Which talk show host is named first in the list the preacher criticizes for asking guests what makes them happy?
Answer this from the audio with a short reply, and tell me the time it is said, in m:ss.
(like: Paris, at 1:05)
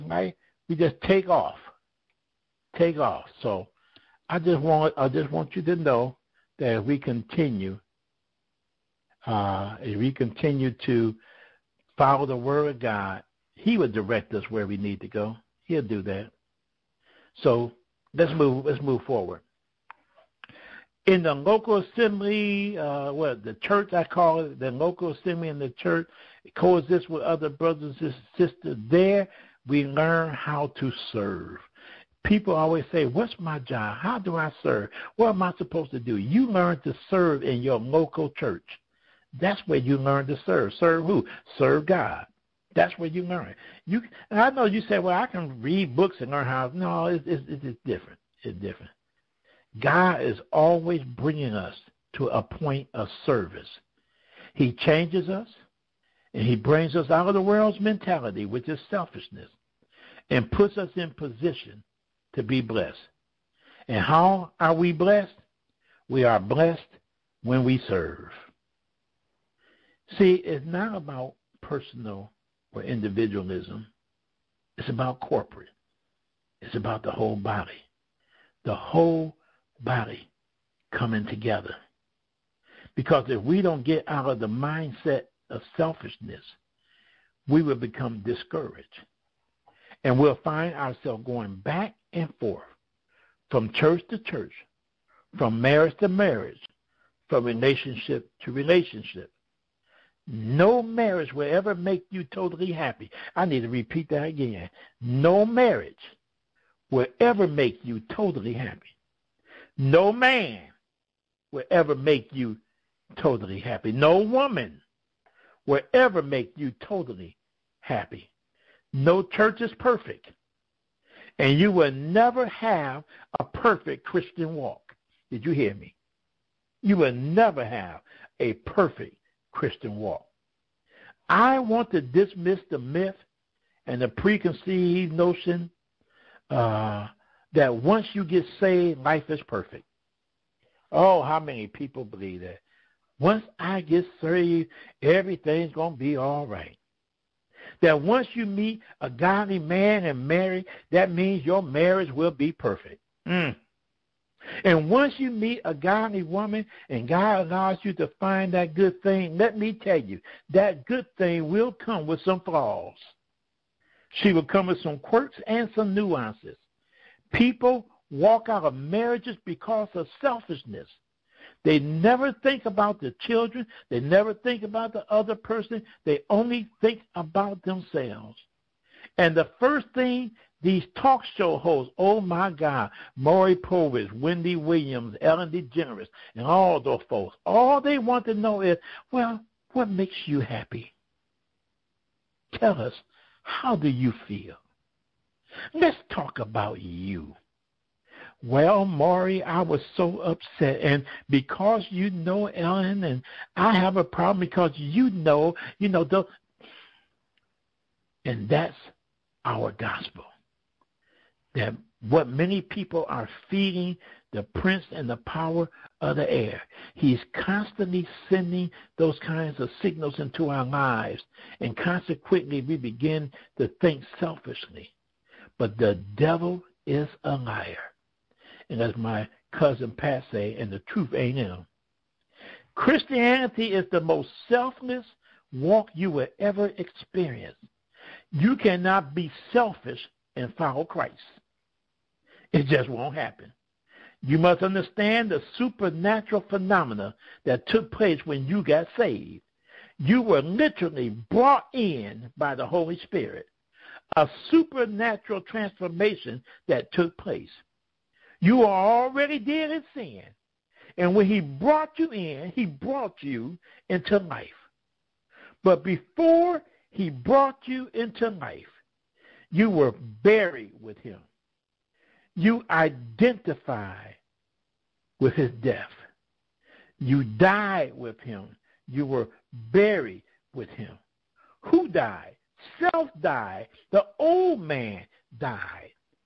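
Maury Povich, at 3:03.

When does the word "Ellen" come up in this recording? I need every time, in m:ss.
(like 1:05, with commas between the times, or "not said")
3:05, 3:22.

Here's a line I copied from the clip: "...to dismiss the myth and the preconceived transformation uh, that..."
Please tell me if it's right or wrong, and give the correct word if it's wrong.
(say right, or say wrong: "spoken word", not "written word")
wrong: "notion", not "transformation".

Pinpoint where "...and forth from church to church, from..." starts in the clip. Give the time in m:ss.
1:32.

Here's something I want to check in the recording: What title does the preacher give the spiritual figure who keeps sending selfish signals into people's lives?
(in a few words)
Prince and the power of the air.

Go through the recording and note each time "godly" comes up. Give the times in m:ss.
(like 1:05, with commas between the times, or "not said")
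2:29, 2:35.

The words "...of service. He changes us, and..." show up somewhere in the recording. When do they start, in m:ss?
0:52.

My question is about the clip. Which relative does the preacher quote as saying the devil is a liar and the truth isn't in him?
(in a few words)
Cousin Pat.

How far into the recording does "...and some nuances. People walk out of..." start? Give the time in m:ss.
2:45.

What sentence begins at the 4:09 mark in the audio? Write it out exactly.
You were literally brought in by the Holy Spirit a supernatural transformation that took place.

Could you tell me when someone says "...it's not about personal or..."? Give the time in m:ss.
1:10.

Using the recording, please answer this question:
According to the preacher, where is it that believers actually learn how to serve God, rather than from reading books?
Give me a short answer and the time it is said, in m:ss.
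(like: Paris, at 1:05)
Local church, at 0:37.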